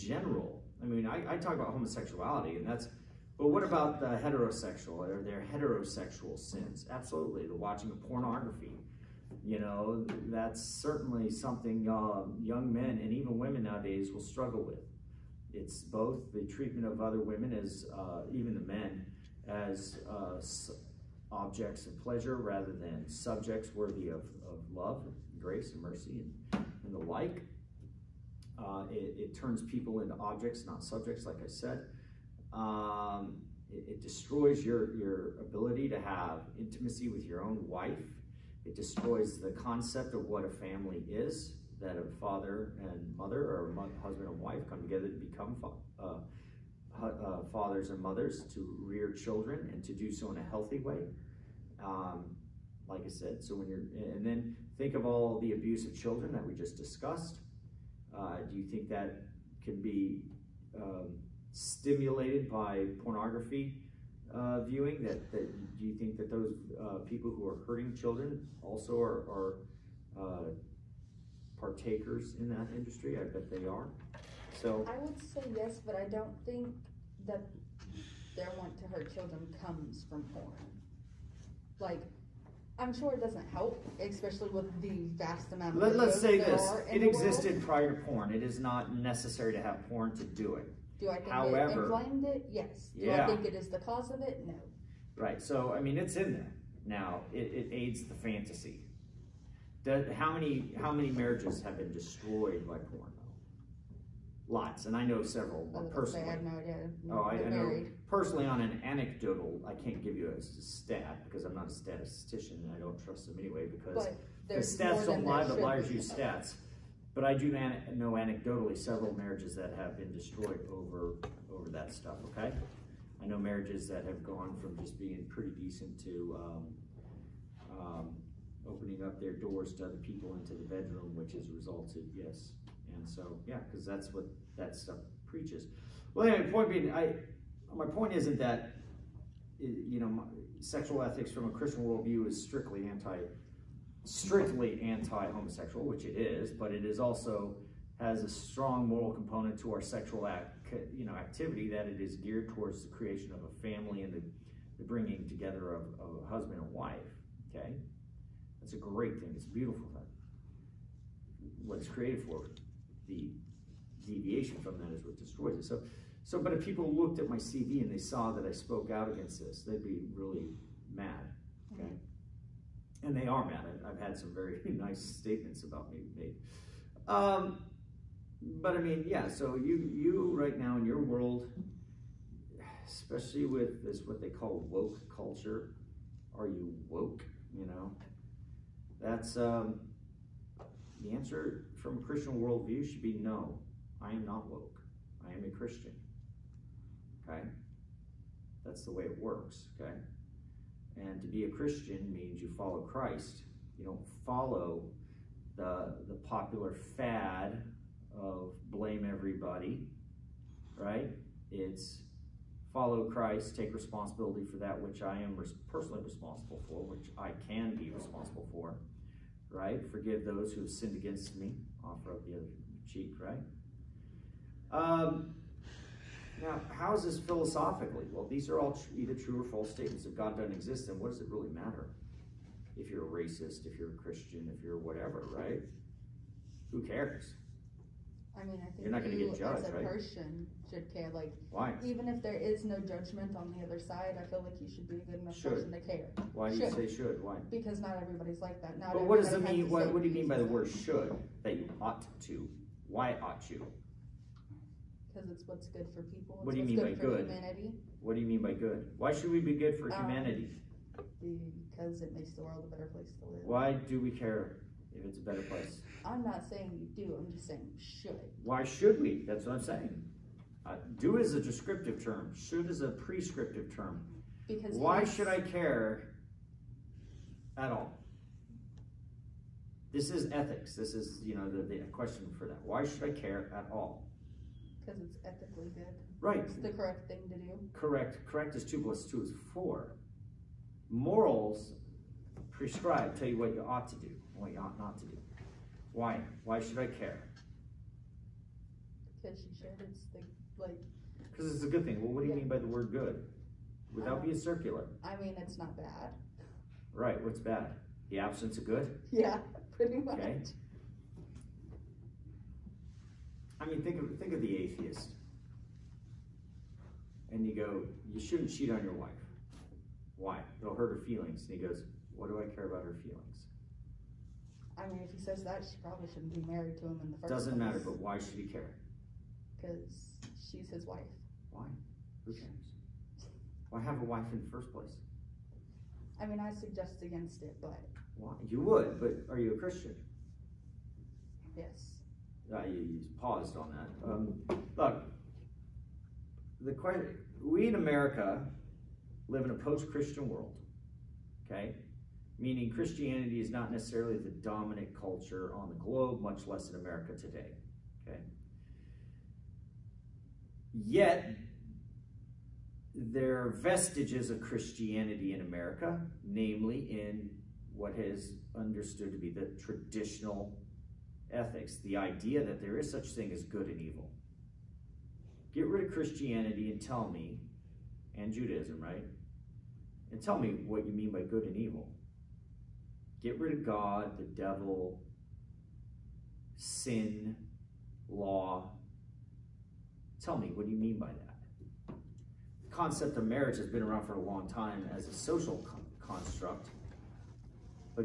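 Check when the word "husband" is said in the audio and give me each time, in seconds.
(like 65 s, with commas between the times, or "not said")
43 s, 156 s.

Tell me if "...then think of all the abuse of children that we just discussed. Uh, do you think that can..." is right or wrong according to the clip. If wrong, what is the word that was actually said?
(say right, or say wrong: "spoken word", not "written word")
right.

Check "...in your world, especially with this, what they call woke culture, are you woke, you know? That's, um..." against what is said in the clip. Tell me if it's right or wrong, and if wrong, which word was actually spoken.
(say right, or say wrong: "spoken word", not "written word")
right.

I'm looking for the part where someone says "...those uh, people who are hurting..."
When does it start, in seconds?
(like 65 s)
66 s.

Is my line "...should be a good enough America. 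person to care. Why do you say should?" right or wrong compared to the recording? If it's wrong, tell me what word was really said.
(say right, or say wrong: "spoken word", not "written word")
wrong: "Should", not "America".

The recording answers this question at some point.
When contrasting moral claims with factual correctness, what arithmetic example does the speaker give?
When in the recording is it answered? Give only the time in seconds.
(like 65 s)
288 s.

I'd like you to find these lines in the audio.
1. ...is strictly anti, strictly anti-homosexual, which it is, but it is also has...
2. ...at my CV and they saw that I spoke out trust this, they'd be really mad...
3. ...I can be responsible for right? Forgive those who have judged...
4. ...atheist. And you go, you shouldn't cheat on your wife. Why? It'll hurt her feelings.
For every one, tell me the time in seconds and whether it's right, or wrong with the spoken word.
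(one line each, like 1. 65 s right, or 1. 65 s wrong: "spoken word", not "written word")
1. 142 s right
2. 167 s wrong: "against", not "trust"
3. 217 s wrong: "sinned", not "judged"
4. 314 s right.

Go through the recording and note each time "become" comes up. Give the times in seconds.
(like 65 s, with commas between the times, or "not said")
45 s.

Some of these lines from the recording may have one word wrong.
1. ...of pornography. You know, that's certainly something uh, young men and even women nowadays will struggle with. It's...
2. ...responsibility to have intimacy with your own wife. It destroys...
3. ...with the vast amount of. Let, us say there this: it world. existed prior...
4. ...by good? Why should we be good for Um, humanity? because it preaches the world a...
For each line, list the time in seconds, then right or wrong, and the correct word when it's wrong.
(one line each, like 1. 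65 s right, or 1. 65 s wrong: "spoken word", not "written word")
1. 7 s right
2. 35 s wrong: "ability", not "responsibility"
3. 84 s right
4. 258 s wrong: "makes", not "preaches".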